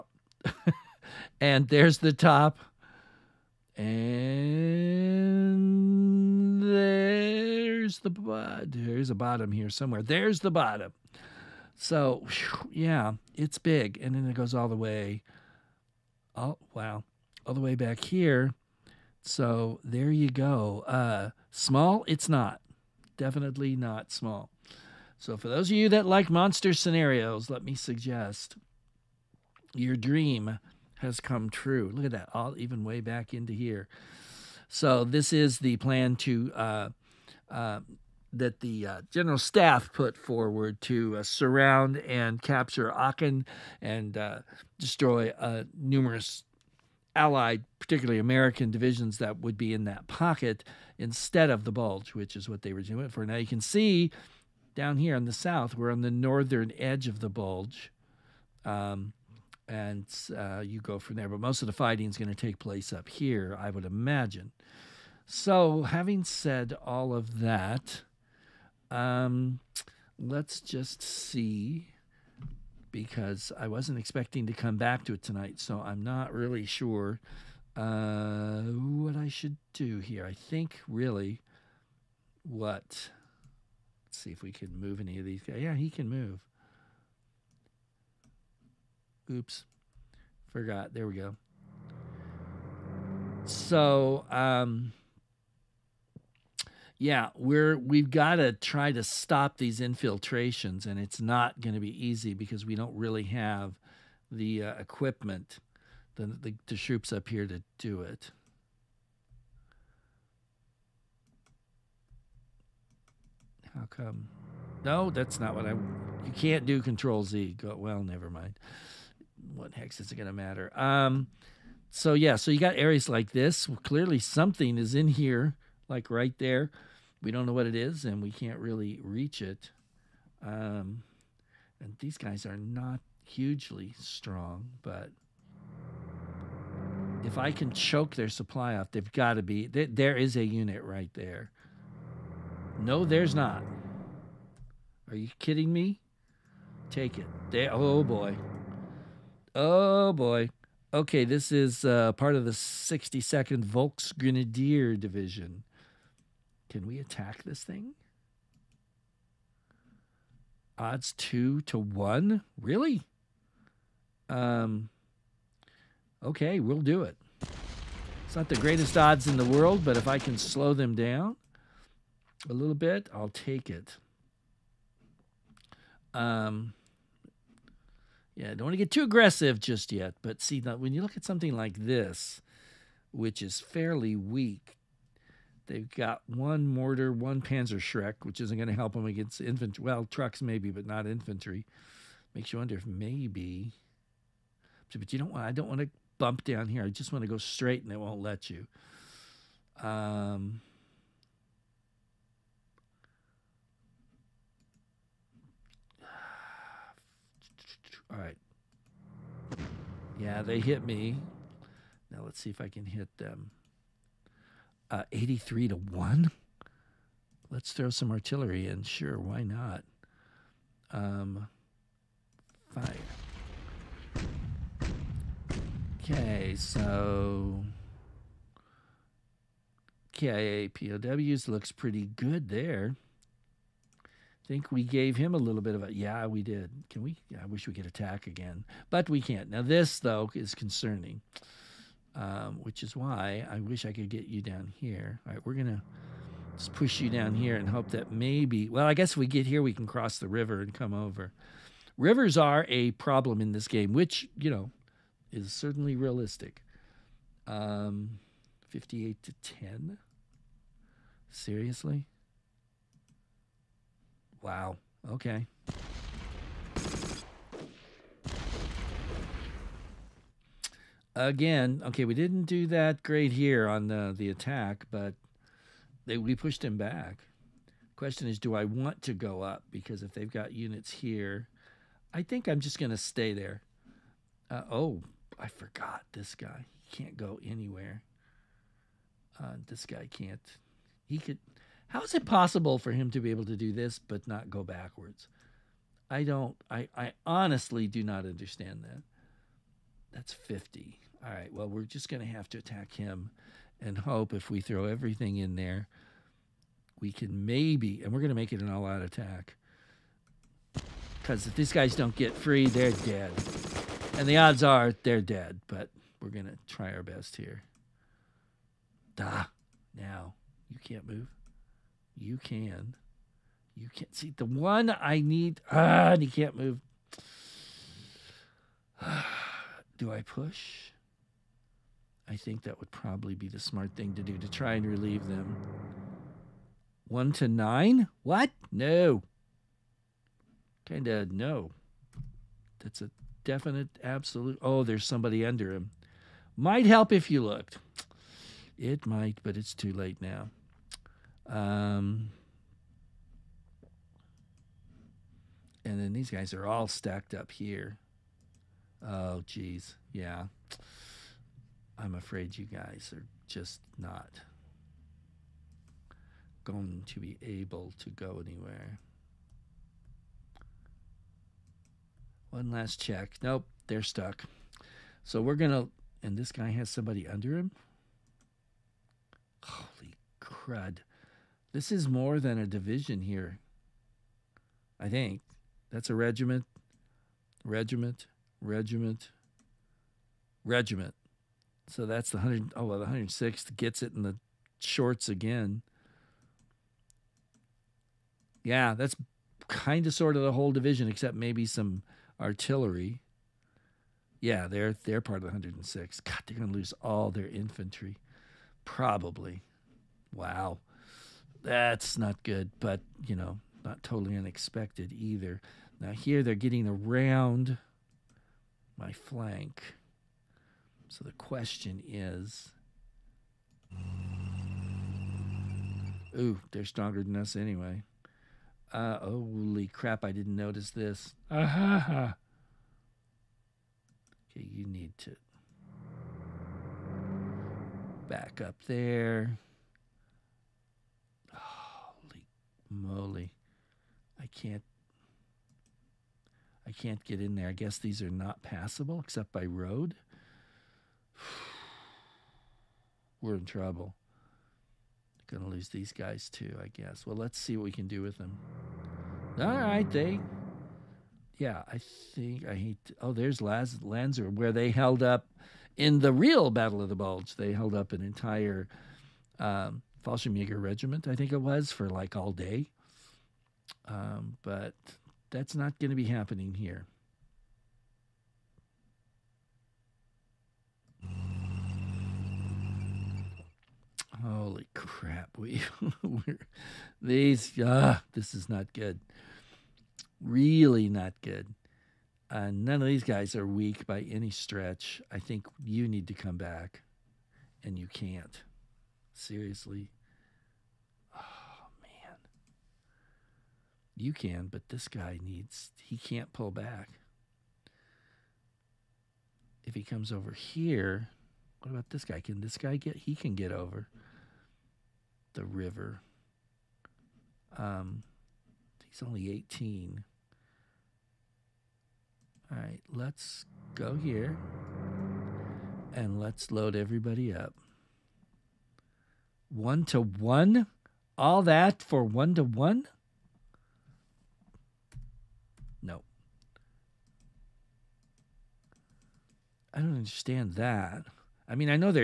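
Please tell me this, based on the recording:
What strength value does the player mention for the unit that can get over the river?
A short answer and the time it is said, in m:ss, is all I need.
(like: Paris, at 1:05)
18, at 8:39.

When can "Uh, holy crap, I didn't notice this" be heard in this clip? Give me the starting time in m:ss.
7:08.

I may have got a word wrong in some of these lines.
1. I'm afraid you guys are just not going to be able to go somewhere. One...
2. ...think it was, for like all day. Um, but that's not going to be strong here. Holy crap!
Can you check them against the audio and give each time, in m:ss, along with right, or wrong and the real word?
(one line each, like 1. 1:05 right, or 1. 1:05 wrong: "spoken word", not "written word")
1. 6:01 wrong: "anywhere", not "somewhere"
2. 7:51 wrong: "happening", not "strong".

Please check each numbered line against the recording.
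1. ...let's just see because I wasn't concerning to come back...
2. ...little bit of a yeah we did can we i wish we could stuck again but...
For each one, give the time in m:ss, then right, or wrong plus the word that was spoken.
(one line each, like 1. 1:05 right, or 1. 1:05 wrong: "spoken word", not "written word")
1. 1:10 wrong: "expecting", not "concerning"
2. 3:55 wrong: "attack", not "stuck".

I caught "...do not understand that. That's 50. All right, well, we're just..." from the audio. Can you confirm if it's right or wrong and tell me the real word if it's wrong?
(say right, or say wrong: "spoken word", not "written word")
right.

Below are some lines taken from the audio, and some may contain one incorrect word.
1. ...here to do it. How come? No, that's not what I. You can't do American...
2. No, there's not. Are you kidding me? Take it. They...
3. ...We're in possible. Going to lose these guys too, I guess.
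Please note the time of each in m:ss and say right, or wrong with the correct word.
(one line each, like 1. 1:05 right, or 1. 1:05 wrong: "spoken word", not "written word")
1. 1:47 wrong: "Control", not "American"
2. 2:22 right
3. 7:33 wrong: "trouble", not "possible".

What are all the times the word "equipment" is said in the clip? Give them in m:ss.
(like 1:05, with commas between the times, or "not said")
1:44.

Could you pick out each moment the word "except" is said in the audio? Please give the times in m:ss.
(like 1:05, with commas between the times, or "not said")
6:41, 7:29.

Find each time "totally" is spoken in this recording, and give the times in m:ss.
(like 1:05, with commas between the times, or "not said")
6:54.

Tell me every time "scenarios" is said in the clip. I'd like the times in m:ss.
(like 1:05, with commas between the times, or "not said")
0:26.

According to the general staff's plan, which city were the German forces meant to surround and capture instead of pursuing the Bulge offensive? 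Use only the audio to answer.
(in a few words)
Aachen.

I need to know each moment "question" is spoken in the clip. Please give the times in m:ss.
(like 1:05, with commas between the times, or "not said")
4:37, 7:01.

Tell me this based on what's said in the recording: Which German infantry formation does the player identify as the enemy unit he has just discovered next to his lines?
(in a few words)
62nd Volksgrenadier Division.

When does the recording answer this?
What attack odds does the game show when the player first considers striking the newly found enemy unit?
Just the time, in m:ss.
2:41.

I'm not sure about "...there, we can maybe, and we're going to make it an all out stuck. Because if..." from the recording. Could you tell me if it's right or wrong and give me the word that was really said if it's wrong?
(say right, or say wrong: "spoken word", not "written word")
wrong: "attack", not "stuck".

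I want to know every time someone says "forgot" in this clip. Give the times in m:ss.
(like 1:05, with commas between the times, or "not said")
1:30, 4:45.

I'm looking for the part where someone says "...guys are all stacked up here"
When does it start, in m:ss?
5:56.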